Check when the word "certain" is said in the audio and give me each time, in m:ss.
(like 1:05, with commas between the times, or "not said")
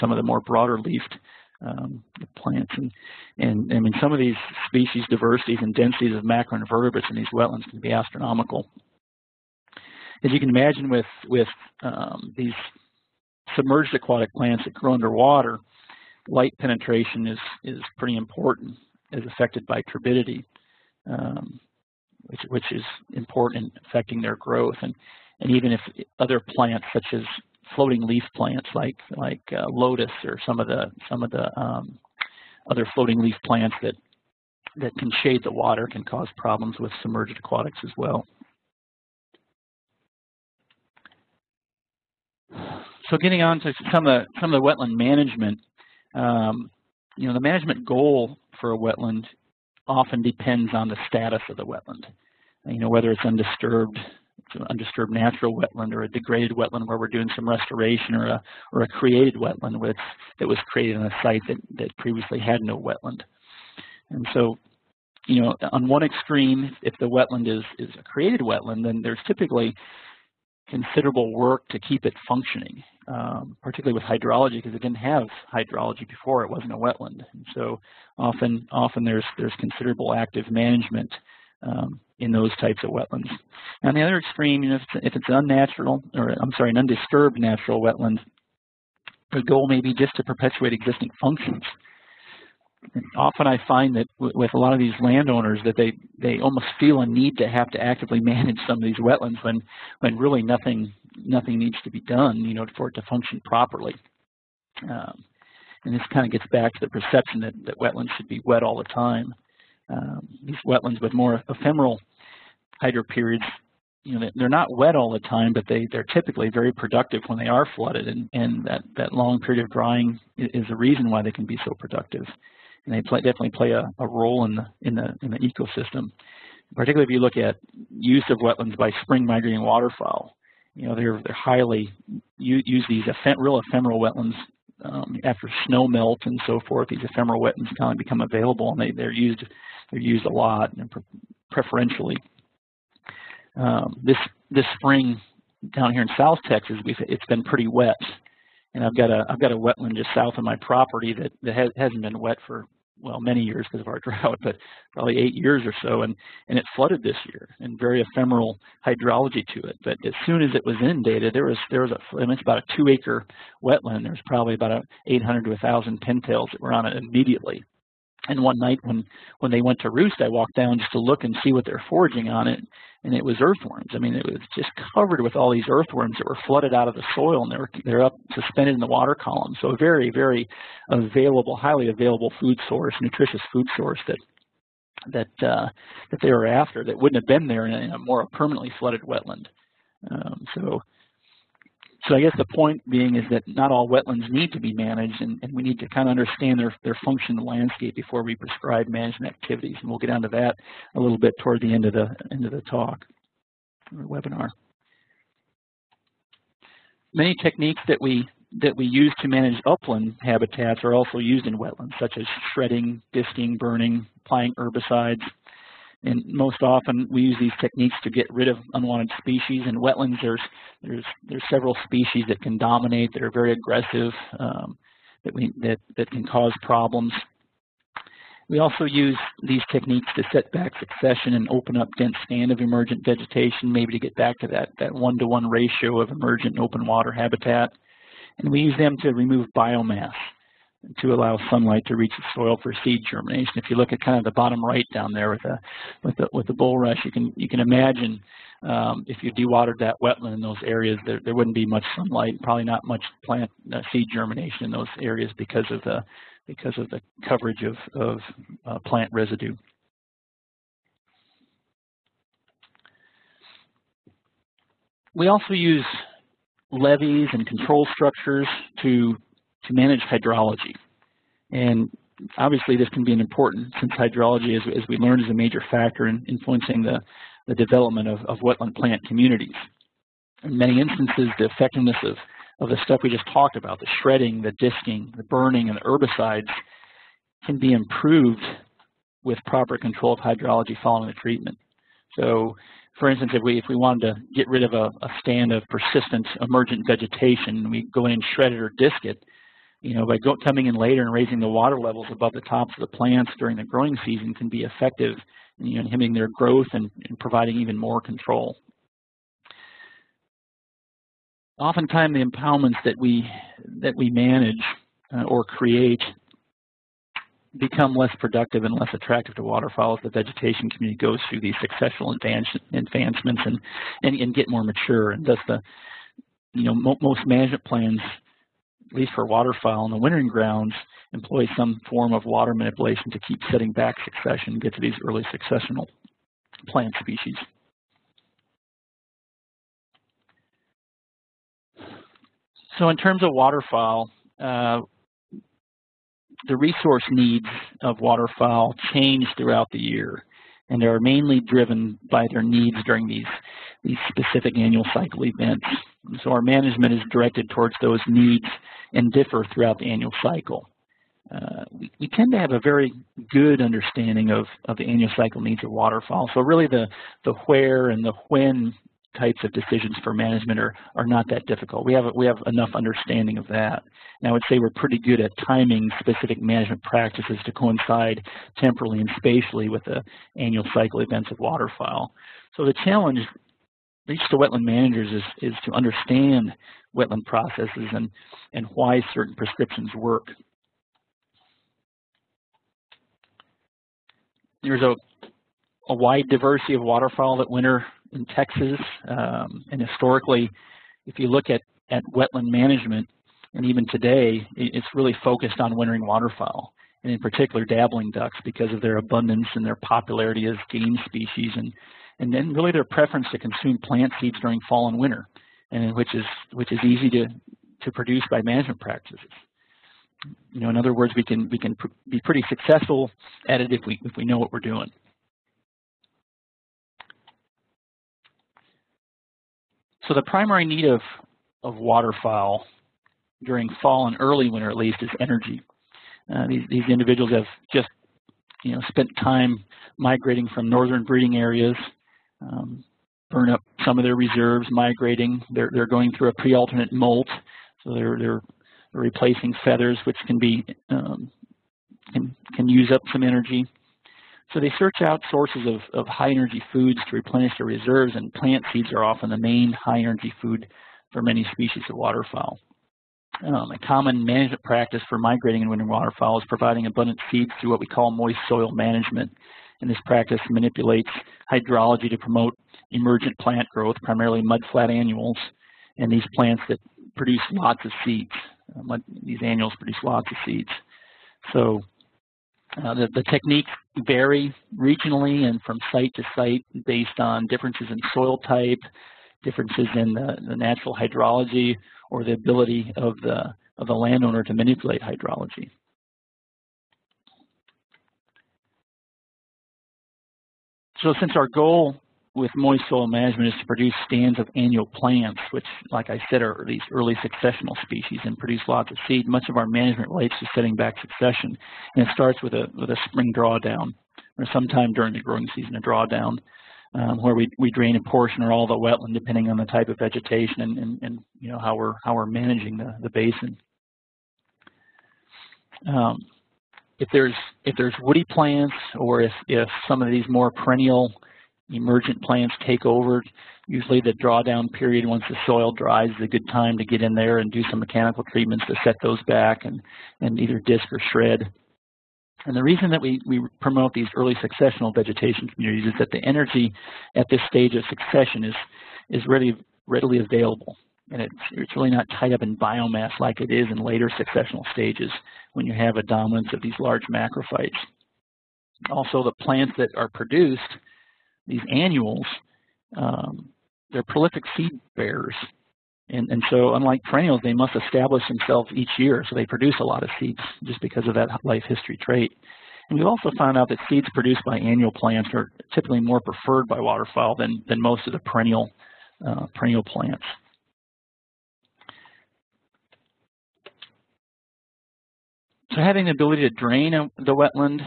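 6:29.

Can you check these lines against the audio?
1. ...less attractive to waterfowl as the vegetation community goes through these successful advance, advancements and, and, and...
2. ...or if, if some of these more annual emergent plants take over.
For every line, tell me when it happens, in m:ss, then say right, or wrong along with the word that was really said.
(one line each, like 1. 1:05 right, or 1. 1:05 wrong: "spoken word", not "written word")
1. 5:18 right
2. 8:48 wrong: "perennial", not "annual".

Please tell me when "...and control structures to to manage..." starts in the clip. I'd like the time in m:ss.
4:27.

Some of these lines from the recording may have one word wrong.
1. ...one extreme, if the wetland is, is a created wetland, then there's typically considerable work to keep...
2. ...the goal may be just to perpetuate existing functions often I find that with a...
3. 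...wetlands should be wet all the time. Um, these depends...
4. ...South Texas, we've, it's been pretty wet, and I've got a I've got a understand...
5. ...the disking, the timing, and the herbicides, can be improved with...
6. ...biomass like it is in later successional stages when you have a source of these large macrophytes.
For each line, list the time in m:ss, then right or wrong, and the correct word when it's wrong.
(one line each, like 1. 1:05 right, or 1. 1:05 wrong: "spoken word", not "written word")
1. 1:05 right
2. 1:29 right
3. 1:47 wrong: "wetlands", not "depends"
4. 2:26 wrong: "wetland", not "understand"
5. 4:44 wrong: "burning", not "timing"
6. 9:12 wrong: "dominance", not "source".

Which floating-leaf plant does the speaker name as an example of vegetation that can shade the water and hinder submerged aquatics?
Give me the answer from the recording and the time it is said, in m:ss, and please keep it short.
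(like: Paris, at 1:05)
lotus, at 0:29.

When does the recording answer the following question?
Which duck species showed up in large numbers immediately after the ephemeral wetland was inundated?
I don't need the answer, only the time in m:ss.
2:46.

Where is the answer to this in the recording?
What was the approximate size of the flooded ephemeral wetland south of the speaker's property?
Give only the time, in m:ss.
2:42.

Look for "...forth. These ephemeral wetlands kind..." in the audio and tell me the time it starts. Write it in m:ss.
2:16.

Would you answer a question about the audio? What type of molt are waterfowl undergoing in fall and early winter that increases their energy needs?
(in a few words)
pre-alternate molt.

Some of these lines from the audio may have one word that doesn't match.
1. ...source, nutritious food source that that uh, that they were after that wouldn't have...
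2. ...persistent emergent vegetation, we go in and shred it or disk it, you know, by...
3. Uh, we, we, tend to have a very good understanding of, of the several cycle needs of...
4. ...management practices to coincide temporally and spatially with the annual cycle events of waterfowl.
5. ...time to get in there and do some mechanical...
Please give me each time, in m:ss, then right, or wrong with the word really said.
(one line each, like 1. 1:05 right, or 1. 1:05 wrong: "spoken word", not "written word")
1. 3:02 right
2. 4:55 right
3. 6:01 wrong: "annual", not "several"
4. 6:16 right
5. 8:56 right.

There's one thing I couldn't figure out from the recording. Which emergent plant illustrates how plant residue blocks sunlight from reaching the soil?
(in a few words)
bulrush.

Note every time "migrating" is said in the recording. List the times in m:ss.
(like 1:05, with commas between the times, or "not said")
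2:09, 7:19, 7:24, 7:45.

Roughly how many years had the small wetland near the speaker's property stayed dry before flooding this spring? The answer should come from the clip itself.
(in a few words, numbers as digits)
8.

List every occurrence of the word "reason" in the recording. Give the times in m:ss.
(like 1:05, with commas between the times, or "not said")
2:00, 9:02.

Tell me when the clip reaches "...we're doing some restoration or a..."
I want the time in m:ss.
0:56.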